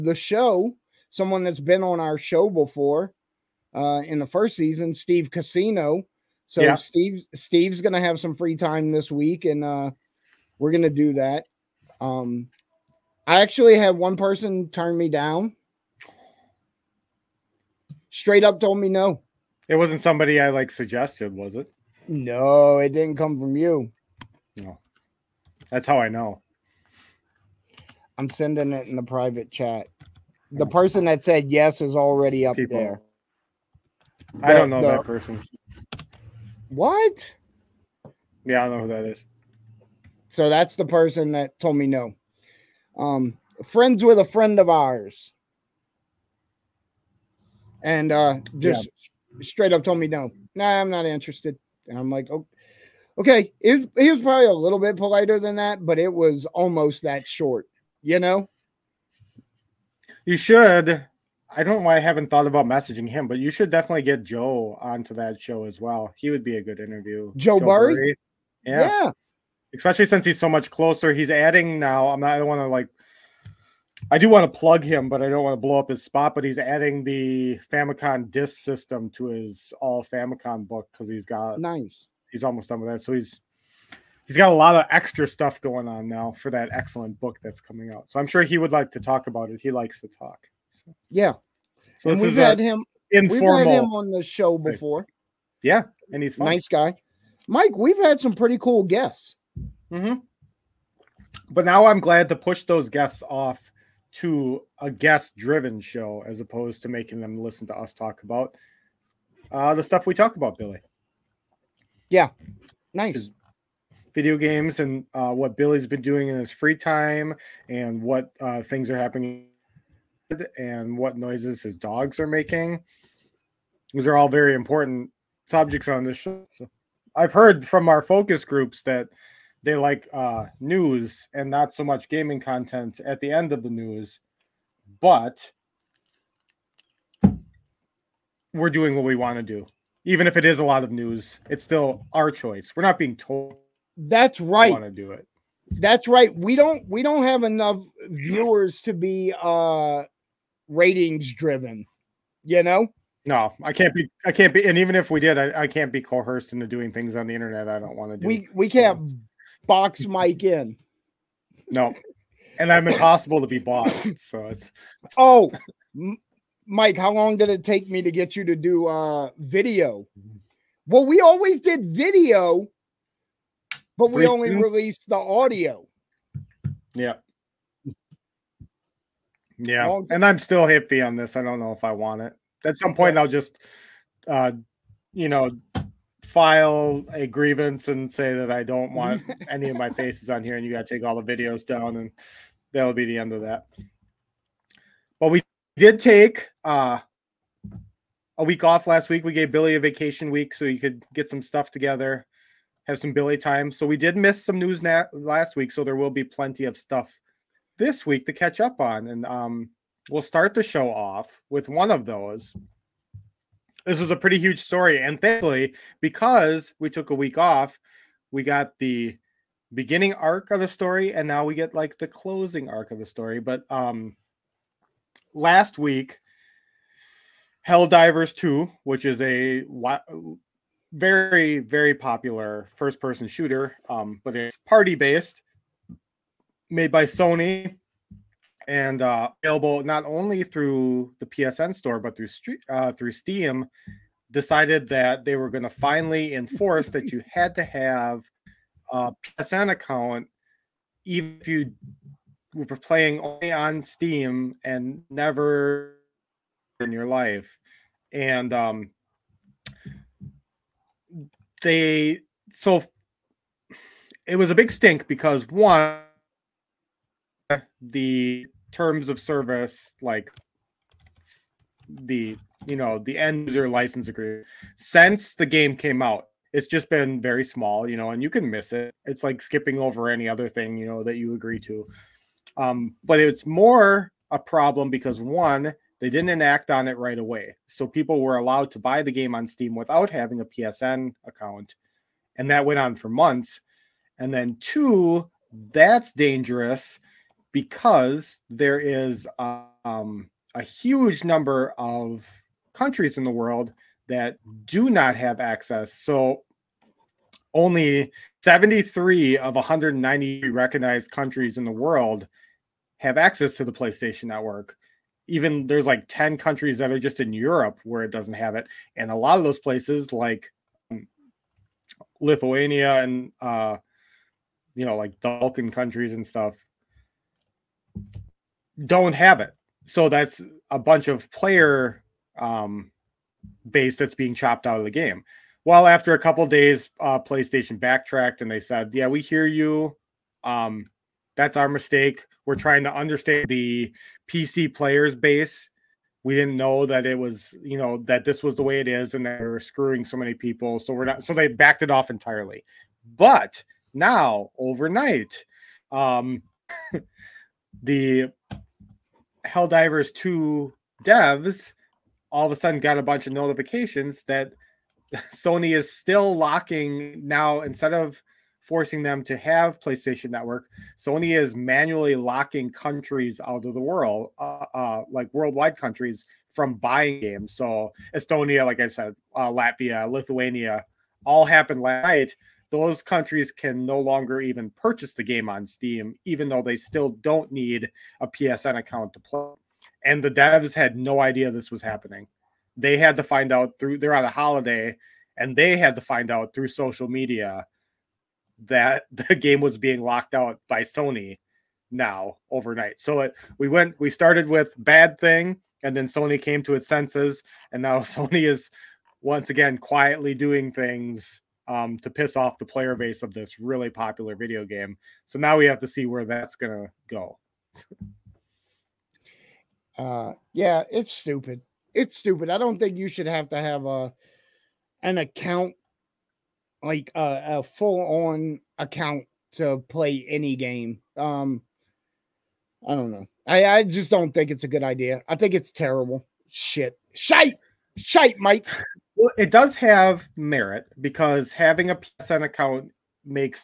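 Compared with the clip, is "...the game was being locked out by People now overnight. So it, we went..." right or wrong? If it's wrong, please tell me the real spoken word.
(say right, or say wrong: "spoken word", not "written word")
wrong: "Sony", not "People".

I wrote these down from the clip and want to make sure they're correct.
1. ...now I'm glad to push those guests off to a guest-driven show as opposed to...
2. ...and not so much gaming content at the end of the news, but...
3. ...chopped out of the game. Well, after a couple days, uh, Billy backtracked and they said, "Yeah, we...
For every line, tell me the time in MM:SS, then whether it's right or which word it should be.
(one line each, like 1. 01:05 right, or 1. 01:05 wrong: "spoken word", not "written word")
1. 01:41 right
2. 02:11 right
3. 05:34 wrong: "PlayStation", not "Billy".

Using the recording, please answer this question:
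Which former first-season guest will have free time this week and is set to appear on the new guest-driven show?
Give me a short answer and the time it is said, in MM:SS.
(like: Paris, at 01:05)
Steve Casino, at 00:04.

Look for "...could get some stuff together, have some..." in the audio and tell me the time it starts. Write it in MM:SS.
03:20.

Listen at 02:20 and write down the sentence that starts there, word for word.
Even if it is a lot of news, it's still our choice.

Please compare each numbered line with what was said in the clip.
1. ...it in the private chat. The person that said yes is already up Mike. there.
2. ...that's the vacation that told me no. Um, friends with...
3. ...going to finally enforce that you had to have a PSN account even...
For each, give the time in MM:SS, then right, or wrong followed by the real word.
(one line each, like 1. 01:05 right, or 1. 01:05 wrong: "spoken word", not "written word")
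1. 00:28 wrong: "People", not "Mike"
2. 00:40 wrong: "person", not "vacation"
3. 04:05 right.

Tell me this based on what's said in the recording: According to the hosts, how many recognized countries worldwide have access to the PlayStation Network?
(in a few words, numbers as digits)
73.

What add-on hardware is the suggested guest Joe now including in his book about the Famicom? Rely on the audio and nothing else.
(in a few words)
Famicom disc system.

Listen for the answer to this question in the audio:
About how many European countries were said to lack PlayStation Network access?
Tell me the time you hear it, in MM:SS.
05:16.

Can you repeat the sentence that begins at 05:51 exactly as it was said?
So they backed it off entirely.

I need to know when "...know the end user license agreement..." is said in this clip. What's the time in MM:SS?
04:32.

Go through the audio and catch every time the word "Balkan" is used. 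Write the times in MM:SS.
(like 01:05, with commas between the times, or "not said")
05:25.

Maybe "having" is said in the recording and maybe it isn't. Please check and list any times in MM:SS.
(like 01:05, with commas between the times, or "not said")
04:50, 07:21.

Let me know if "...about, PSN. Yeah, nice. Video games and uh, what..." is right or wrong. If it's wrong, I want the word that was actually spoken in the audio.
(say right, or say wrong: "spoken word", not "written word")
wrong: "Billy", not "PSN".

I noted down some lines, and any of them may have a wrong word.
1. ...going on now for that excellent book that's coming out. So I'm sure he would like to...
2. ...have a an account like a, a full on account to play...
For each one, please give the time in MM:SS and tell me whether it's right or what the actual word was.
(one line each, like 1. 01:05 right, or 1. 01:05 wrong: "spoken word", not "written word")
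1. 01:25 right
2. 07:03 right.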